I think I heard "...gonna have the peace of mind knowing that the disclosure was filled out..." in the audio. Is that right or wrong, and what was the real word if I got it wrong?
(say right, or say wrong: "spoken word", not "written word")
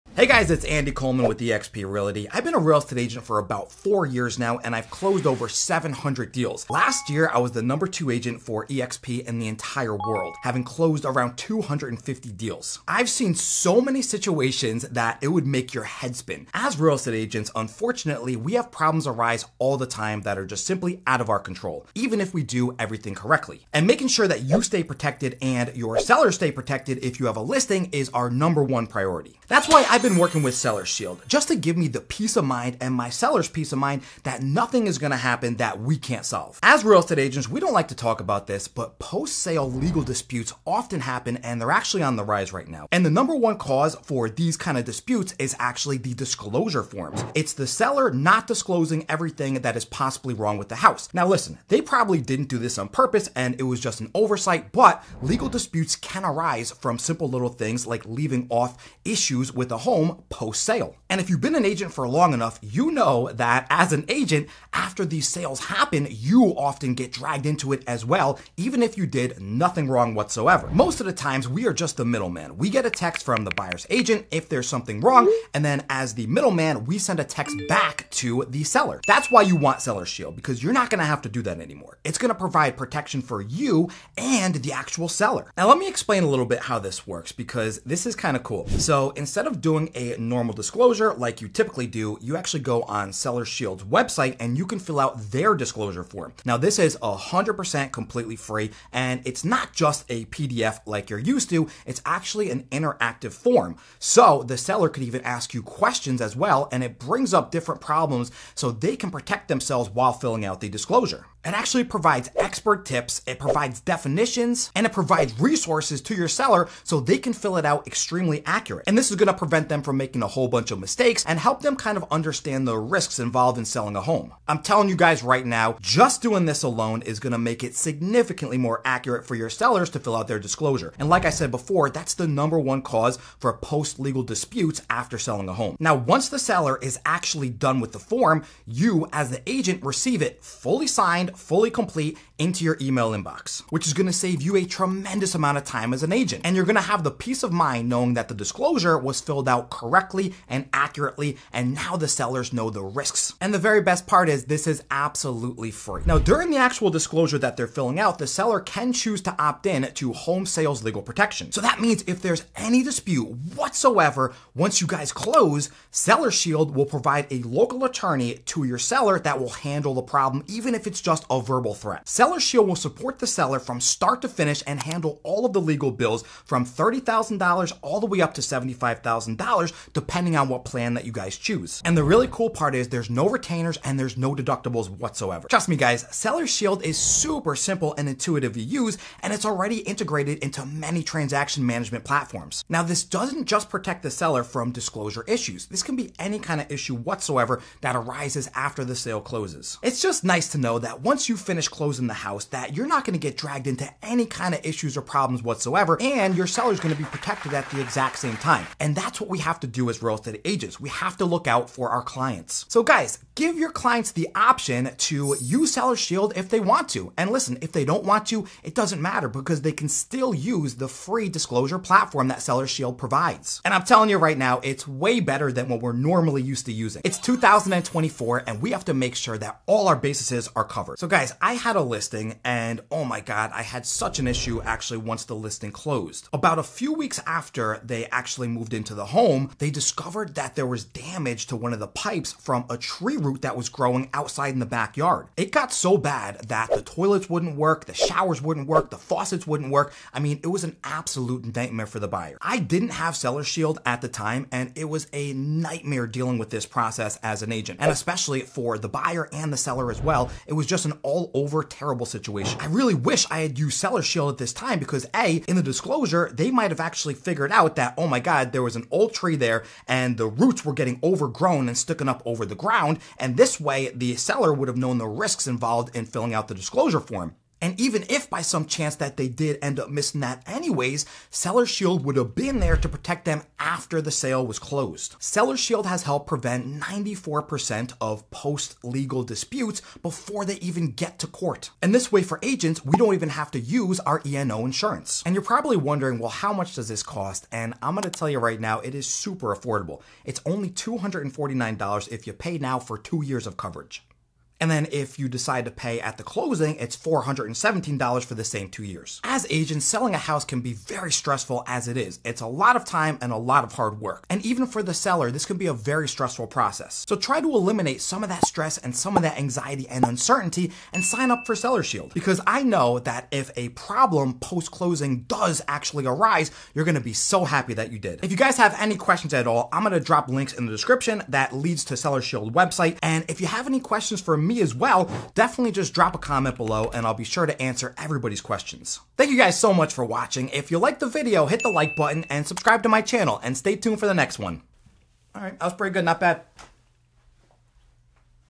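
right.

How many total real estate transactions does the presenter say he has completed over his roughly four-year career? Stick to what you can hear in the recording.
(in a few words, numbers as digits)
over 700.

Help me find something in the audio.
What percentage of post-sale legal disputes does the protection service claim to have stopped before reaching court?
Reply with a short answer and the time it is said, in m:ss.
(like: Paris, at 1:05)
94%, at 4:46.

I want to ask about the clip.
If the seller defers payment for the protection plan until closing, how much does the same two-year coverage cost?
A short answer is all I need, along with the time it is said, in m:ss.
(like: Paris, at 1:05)
$417, at 5:06.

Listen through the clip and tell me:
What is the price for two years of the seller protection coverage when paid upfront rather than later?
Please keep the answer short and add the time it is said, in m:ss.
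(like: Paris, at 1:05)
$249, at 5:00.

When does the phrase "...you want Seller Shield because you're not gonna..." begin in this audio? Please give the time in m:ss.
1:19.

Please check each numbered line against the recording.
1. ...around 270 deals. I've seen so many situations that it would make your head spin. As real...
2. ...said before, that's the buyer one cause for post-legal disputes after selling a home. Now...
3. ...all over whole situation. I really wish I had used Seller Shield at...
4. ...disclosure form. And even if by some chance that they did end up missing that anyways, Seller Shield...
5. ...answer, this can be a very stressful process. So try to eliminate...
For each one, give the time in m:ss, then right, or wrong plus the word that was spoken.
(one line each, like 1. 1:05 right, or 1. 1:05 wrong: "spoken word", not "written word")
1. 0:11 wrong: "250", not "270"
2. 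2:11 wrong: "number", not "buyer"
3. 4:21 wrong: "terrible", not "whole"
4. 4:36 right
5. 5:14 wrong: "seller", not "answer".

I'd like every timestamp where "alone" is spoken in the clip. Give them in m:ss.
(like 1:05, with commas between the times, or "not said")
2:06.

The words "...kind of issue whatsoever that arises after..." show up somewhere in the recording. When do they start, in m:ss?
3:16.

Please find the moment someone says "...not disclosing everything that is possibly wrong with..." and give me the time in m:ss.
0:48.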